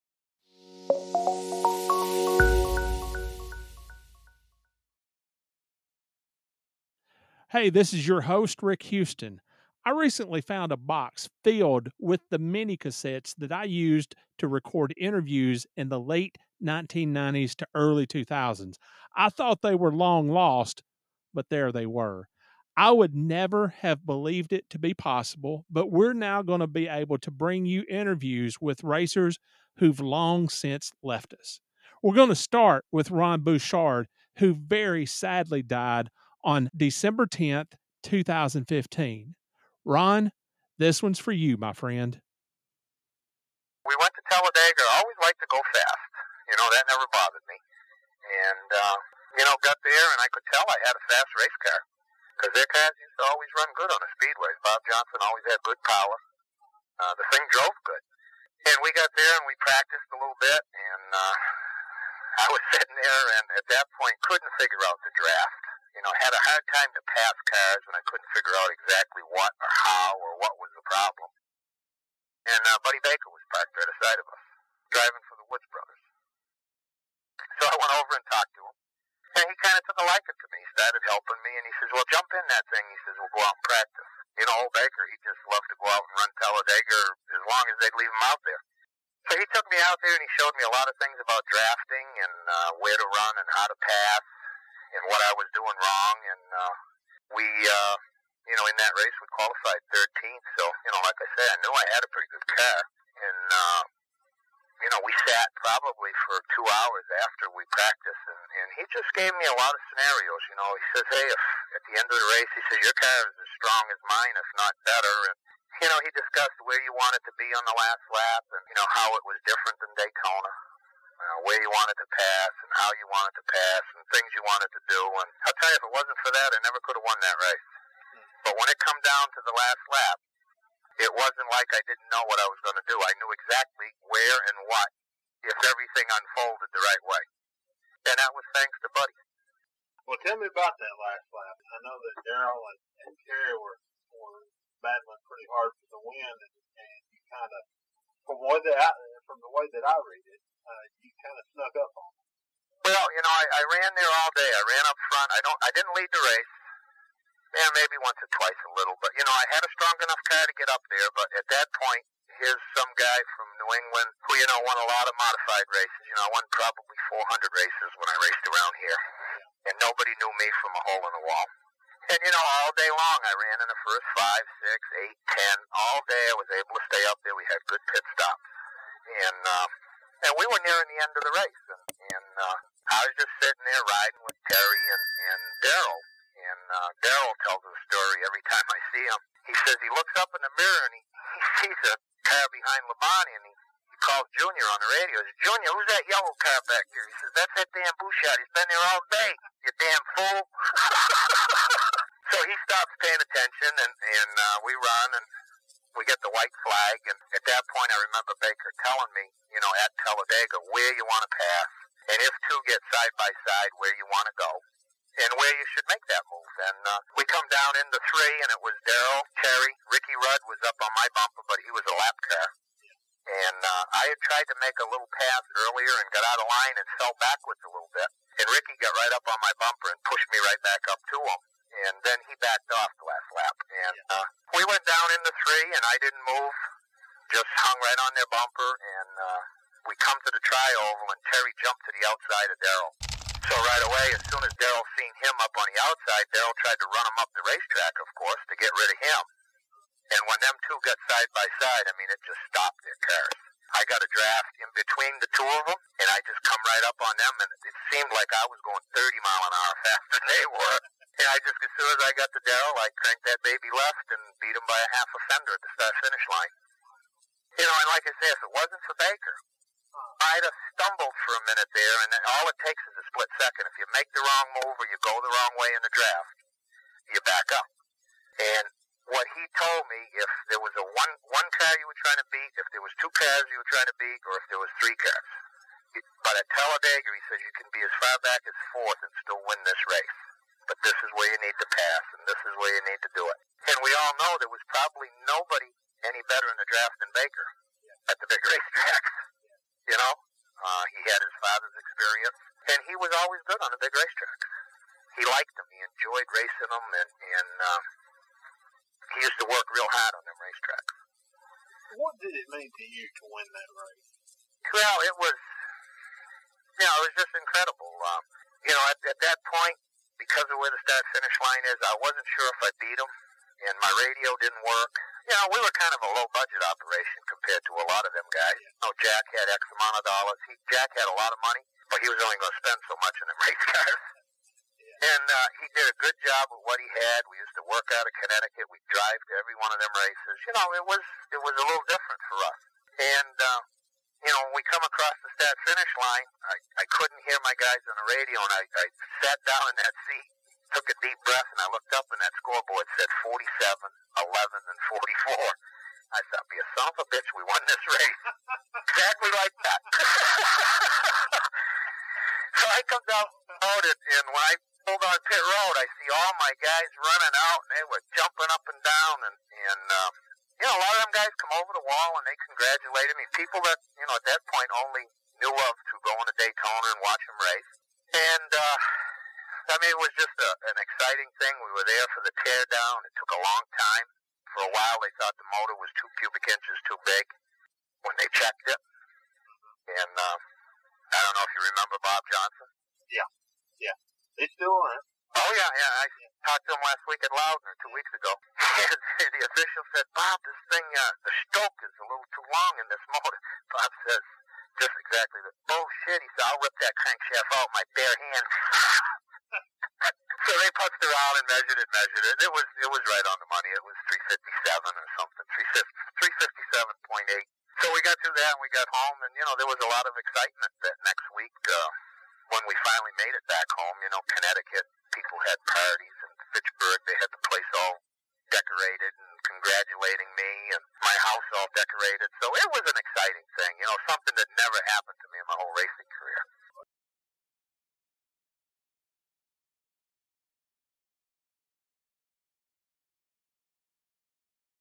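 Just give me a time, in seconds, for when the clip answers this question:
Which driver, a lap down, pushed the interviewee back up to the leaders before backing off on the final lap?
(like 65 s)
219 s.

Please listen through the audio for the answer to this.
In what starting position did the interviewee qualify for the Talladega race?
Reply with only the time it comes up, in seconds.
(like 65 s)
99 s.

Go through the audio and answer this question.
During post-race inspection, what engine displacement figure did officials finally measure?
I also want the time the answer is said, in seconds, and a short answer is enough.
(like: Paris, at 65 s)
357.8, at 416 s.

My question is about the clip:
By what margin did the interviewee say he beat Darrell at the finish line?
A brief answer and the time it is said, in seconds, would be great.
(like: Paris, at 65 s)
half a fender, at 264 s.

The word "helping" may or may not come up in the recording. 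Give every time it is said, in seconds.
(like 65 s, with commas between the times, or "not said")
81 s.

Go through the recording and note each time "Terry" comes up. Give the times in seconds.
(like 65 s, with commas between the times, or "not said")
143 s, 184 s, 219 s, 241 s.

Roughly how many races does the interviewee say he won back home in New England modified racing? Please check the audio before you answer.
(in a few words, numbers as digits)
400.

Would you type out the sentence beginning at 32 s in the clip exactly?
We're going to start with Ron Bouchard, who very sadly died on December 10th, 2015.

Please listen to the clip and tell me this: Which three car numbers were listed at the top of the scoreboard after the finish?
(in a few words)
47, 11, and 44.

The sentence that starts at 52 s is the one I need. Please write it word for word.
Because their cars used to always run good on the speedways.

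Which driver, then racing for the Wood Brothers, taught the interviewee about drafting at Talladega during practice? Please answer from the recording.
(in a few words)
Buddy Baker.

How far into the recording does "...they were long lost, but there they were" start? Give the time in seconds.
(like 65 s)
19 s.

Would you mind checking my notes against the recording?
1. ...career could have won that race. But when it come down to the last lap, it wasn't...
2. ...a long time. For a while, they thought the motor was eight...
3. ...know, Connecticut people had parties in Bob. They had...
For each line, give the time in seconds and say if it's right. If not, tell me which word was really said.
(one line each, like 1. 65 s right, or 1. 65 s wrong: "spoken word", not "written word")
1. 126 s wrong: "never", not "career"
2. 383 s wrong: "two", not "eight"
3. 424 s wrong: "Fitchburg", not "Bob".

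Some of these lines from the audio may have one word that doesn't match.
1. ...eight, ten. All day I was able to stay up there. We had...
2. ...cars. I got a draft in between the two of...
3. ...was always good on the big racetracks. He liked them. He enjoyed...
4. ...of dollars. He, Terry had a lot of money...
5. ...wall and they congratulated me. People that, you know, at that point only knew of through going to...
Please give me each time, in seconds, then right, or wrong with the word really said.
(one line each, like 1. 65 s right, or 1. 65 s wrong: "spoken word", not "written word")
1. 175 s right
2. 252 s right
3. 303 s right
4. 329 s wrong: "Jack", not "Terry"
5. 371 s right.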